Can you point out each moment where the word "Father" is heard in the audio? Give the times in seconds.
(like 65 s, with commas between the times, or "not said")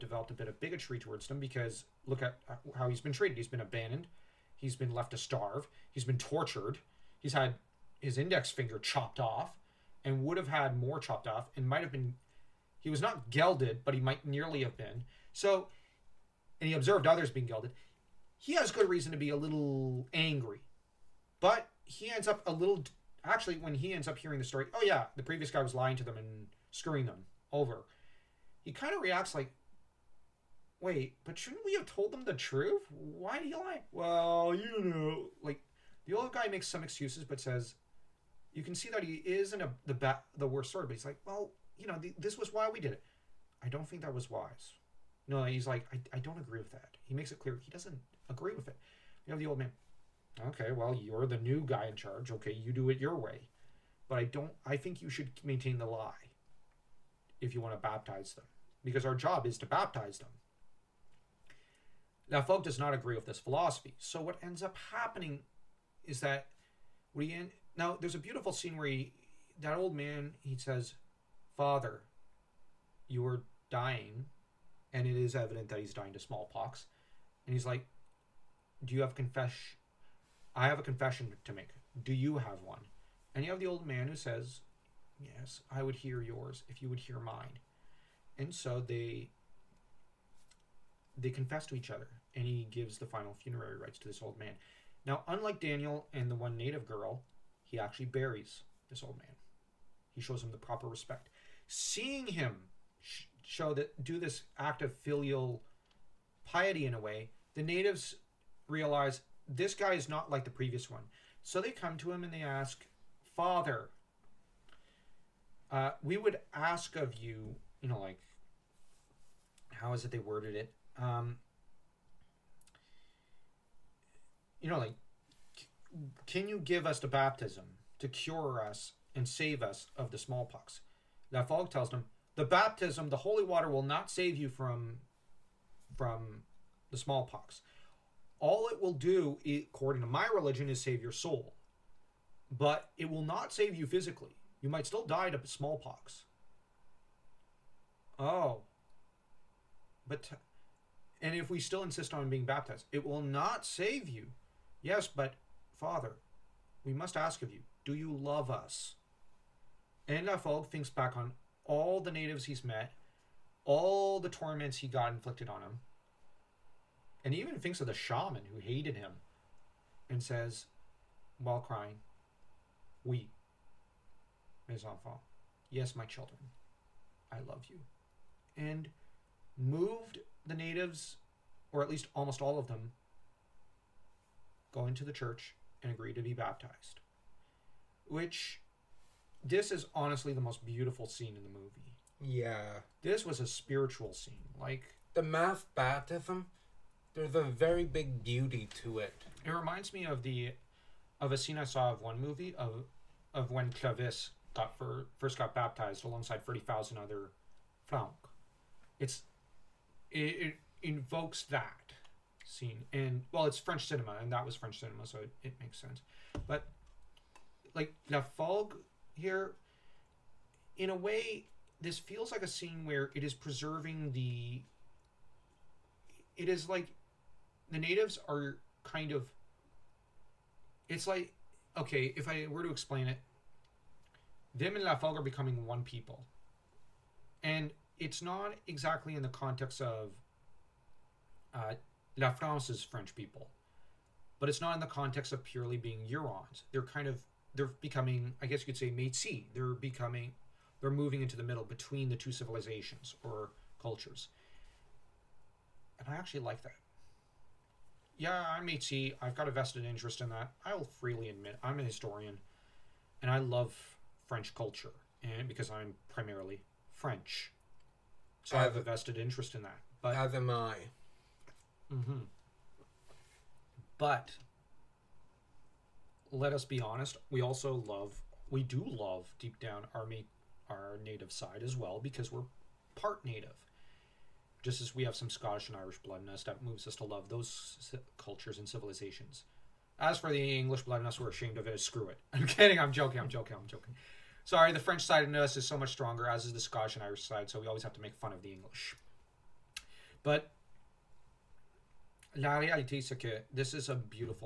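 71 s, 113 s, 155 s.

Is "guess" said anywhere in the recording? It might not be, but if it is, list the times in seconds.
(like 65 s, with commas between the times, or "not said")
248 s.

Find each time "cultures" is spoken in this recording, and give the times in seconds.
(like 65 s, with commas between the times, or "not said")
253 s, 264 s, 288 s.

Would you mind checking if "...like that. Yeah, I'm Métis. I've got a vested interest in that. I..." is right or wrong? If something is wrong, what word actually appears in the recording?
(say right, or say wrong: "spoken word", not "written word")
right.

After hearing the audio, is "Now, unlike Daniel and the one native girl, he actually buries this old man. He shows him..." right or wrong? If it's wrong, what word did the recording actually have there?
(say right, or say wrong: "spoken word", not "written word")
right.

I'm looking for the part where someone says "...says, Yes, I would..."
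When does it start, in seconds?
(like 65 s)
84 s.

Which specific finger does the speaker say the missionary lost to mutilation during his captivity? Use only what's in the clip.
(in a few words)
Index finger.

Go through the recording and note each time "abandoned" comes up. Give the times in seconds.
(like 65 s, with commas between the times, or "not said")
3 s.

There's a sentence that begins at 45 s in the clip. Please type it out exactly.
No, he's like, I, I don't agree with that.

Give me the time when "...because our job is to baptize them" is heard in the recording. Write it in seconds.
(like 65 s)
58 s.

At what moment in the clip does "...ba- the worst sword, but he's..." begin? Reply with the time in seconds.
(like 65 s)
39 s.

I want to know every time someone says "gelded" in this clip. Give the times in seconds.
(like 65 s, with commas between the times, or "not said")
13 s, 17 s.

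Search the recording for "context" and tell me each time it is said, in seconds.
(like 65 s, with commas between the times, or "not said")
239 s, 244 s.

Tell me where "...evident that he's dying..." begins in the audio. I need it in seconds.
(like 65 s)
75 s.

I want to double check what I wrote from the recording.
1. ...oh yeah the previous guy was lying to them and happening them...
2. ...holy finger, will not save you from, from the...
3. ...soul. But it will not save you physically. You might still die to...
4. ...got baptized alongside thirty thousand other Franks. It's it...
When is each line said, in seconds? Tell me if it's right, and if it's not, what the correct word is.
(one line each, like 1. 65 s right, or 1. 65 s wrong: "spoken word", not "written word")
1. 24 s wrong: "screwing", not "happening"
2. 133 s wrong: "water", not "finger"
3. 141 s right
4. 205 s right.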